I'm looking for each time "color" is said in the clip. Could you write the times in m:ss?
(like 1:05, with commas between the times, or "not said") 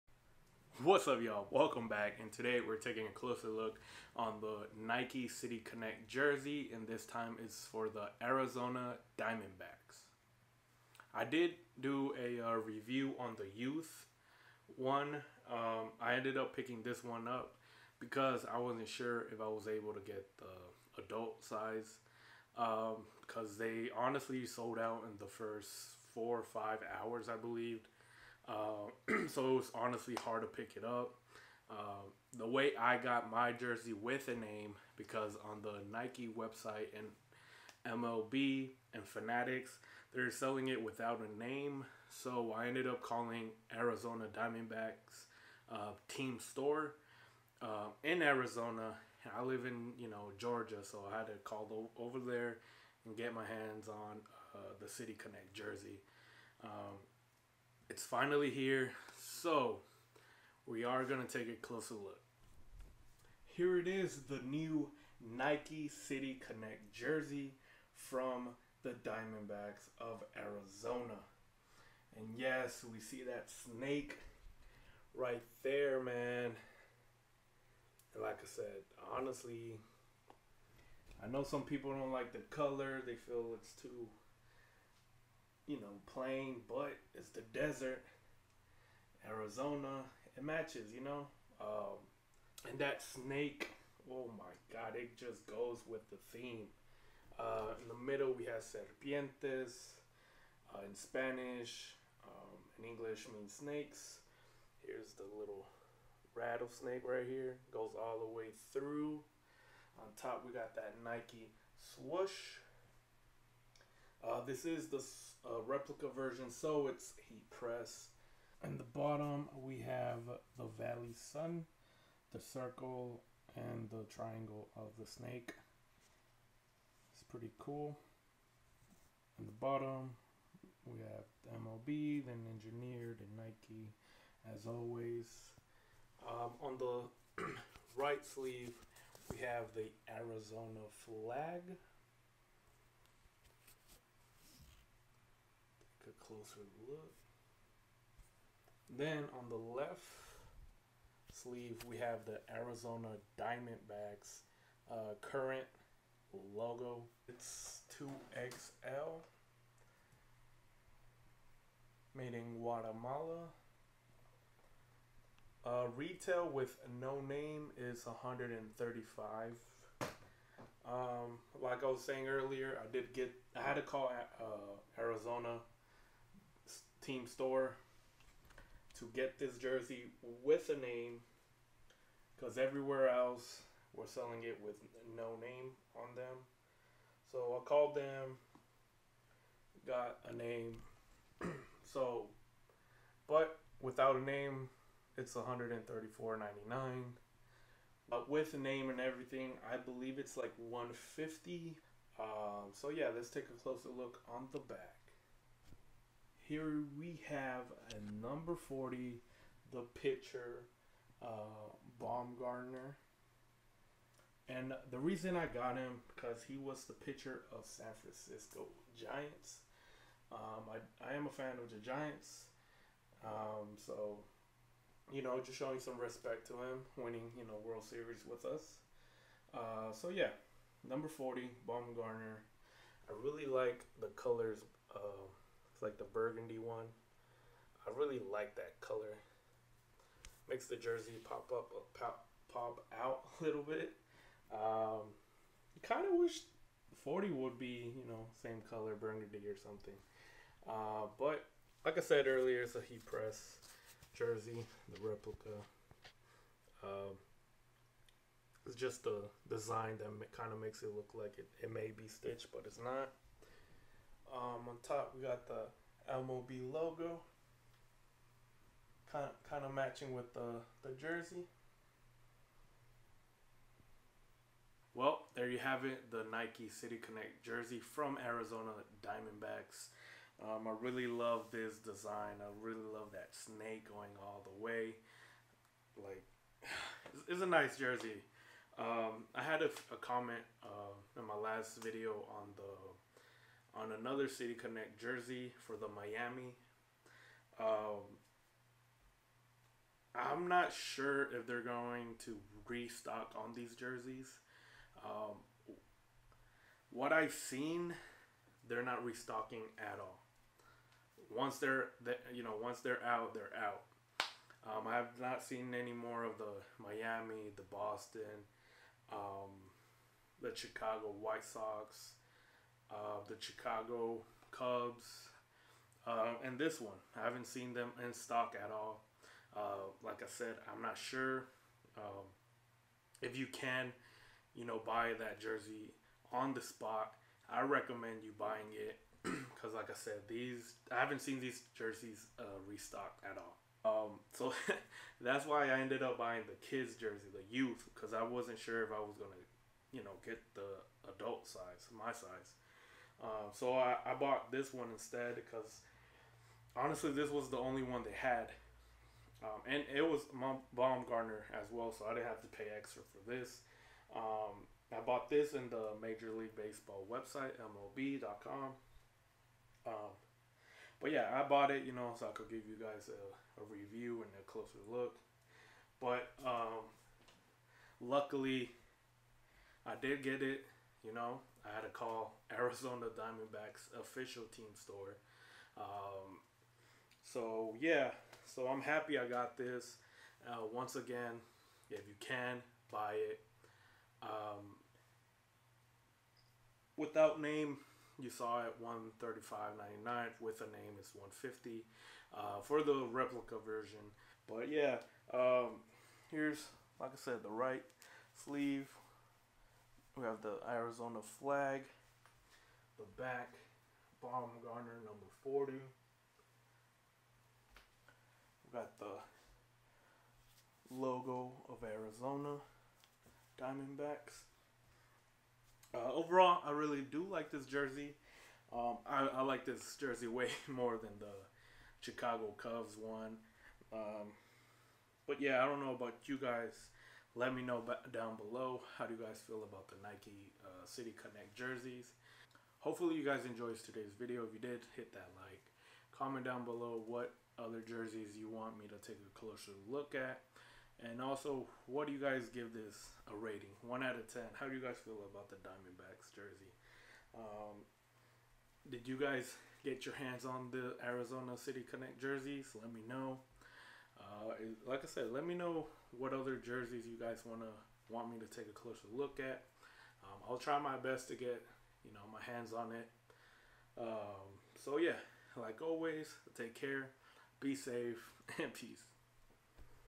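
1:22, 3:54, 3:58, 4:08.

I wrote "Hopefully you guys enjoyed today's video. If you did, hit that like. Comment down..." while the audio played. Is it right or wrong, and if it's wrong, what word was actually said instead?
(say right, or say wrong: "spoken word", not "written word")
right.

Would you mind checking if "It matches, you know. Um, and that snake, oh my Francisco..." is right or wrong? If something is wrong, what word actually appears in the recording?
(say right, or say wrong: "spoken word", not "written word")
wrong: "God", not "Francisco".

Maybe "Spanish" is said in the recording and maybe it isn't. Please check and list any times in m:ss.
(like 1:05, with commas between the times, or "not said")
1:40.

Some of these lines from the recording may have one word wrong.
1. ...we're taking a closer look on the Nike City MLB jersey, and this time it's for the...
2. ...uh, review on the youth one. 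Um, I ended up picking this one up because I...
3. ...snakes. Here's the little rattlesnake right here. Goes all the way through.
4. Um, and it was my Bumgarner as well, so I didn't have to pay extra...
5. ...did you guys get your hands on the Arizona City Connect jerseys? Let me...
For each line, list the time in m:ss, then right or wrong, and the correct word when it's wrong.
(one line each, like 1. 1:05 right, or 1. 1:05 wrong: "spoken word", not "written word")
1. 0:02 wrong: "Connect", not "MLB"
2. 0:12 right
3. 1:43 right
4. 5:59 right
5. 7:38 right.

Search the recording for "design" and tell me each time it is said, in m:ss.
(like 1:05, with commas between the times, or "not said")
4:19, 4:41.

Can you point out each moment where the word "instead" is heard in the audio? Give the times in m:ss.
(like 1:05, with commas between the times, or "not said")
5:54.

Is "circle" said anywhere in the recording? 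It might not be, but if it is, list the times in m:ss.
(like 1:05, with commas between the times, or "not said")
2:02.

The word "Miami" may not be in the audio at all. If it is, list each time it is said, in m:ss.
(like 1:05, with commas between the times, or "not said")
4:55, 5:16.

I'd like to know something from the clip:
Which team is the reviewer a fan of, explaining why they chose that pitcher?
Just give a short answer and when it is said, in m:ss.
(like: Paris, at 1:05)
San Francisco Giants, at 3:37.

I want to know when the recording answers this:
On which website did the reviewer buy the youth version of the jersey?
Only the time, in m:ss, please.
6:07.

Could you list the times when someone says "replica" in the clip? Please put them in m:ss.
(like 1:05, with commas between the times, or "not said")
1:55, 4:15, 6:43.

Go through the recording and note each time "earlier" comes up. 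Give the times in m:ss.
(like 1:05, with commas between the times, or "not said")
2:52, 4:12.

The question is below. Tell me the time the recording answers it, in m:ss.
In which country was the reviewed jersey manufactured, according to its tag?
2:42.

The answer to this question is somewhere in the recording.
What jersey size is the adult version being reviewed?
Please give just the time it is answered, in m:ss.
2:37.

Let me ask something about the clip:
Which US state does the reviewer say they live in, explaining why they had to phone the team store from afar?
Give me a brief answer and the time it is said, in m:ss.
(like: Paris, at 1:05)
Georgia, at 0:50.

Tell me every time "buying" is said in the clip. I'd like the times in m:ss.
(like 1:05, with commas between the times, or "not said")
5:38, 5:46.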